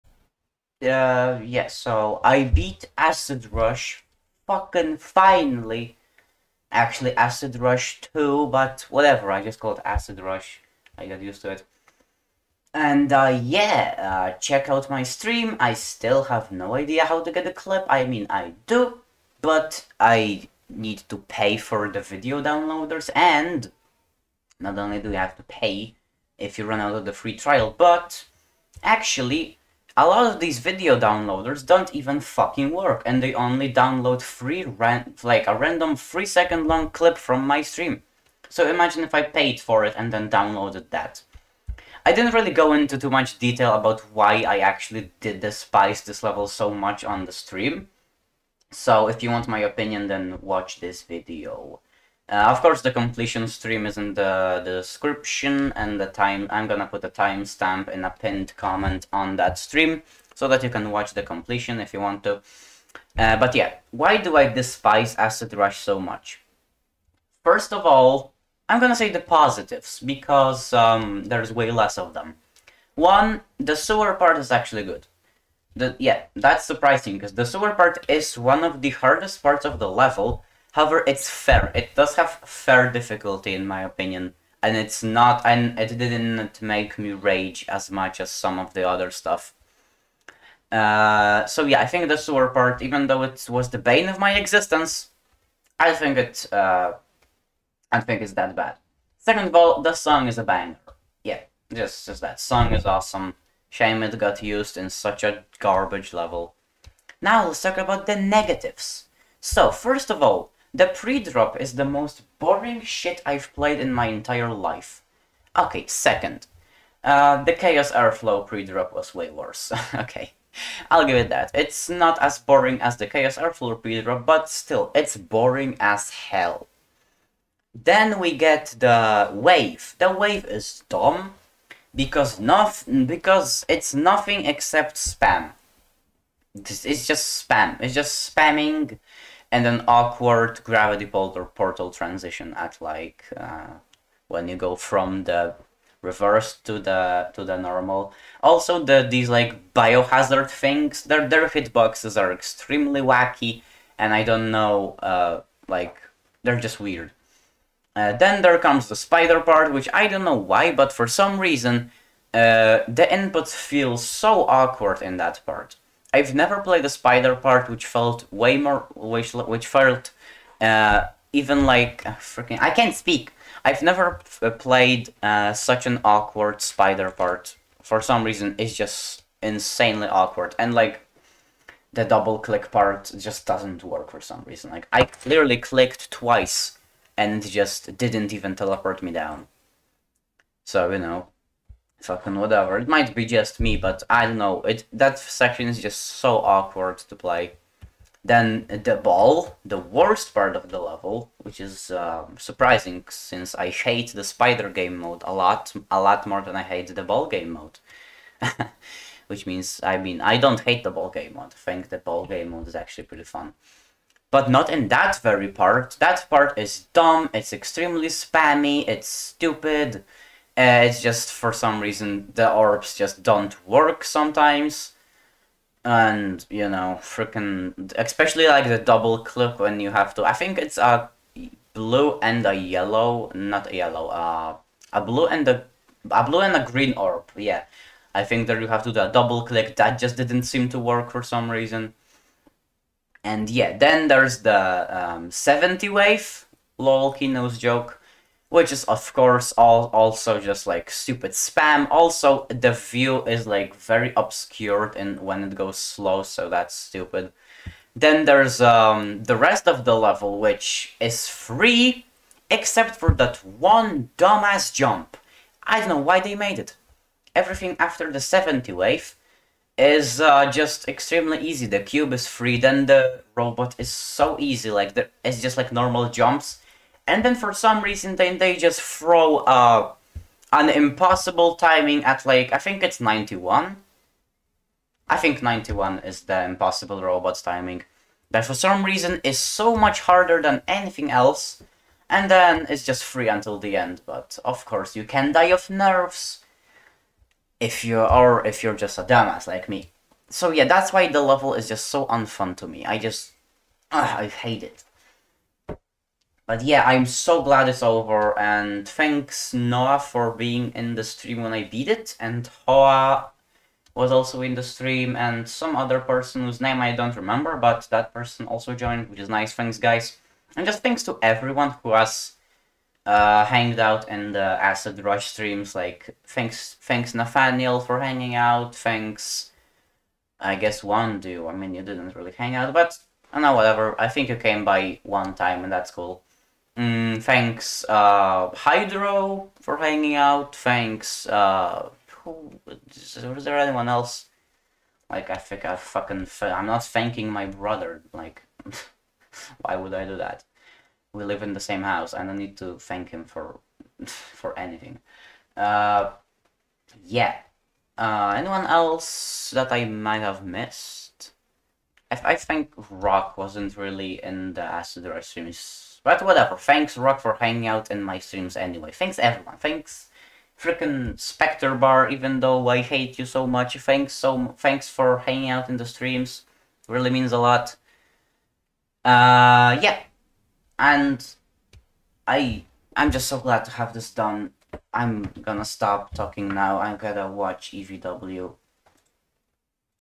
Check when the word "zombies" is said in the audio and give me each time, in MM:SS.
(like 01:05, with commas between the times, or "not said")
not said.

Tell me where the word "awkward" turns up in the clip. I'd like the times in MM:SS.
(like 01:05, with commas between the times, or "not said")
02:19, 02:44, 02:56, 03:00, 03:16.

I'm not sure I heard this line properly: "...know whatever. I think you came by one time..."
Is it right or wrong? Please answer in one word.
right.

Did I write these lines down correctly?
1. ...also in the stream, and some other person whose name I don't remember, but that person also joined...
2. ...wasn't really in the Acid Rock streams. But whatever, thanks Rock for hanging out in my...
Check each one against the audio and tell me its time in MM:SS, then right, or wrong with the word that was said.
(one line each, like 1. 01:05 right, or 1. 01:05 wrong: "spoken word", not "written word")
1. 05:14 right
2. 06:03 right.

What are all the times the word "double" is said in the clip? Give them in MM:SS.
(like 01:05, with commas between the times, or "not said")
03:02, 03:48, 03:59.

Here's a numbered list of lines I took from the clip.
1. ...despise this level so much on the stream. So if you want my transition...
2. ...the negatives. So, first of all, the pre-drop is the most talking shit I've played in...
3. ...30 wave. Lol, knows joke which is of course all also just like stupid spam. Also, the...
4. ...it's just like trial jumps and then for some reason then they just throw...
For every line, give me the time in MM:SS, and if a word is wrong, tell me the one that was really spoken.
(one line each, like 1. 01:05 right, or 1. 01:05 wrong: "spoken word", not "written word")
1. 00:45 wrong: "opinion", not "transition"
2. 01:48 wrong: "boring", not "talking"
3. 04:05 wrong: "70", not "30"
4. 04:35 wrong: "normal", not "trial".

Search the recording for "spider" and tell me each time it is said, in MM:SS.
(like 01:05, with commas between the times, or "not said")
02:38, 02:46, 02:56, 03:24.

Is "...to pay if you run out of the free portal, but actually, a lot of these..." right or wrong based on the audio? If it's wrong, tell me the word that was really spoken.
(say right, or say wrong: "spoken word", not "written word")
wrong: "trial", not "portal".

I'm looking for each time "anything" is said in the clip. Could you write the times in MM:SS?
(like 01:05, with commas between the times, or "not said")
04:50, 05:54.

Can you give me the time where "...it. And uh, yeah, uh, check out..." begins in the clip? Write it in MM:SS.
00:11.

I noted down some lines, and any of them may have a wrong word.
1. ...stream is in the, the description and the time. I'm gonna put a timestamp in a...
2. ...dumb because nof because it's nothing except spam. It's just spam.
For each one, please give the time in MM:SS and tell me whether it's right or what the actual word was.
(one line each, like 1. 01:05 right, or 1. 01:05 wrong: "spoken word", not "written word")
1. 00:53 right
2. 02:10 right.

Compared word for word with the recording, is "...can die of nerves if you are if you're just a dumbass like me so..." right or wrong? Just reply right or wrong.
right.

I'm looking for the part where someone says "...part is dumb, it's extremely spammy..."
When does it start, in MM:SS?
03:36.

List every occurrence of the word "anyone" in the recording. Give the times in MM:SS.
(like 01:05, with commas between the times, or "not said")
05:43, 05:58.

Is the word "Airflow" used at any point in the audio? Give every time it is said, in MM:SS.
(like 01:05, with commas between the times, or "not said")
01:57, 02:03.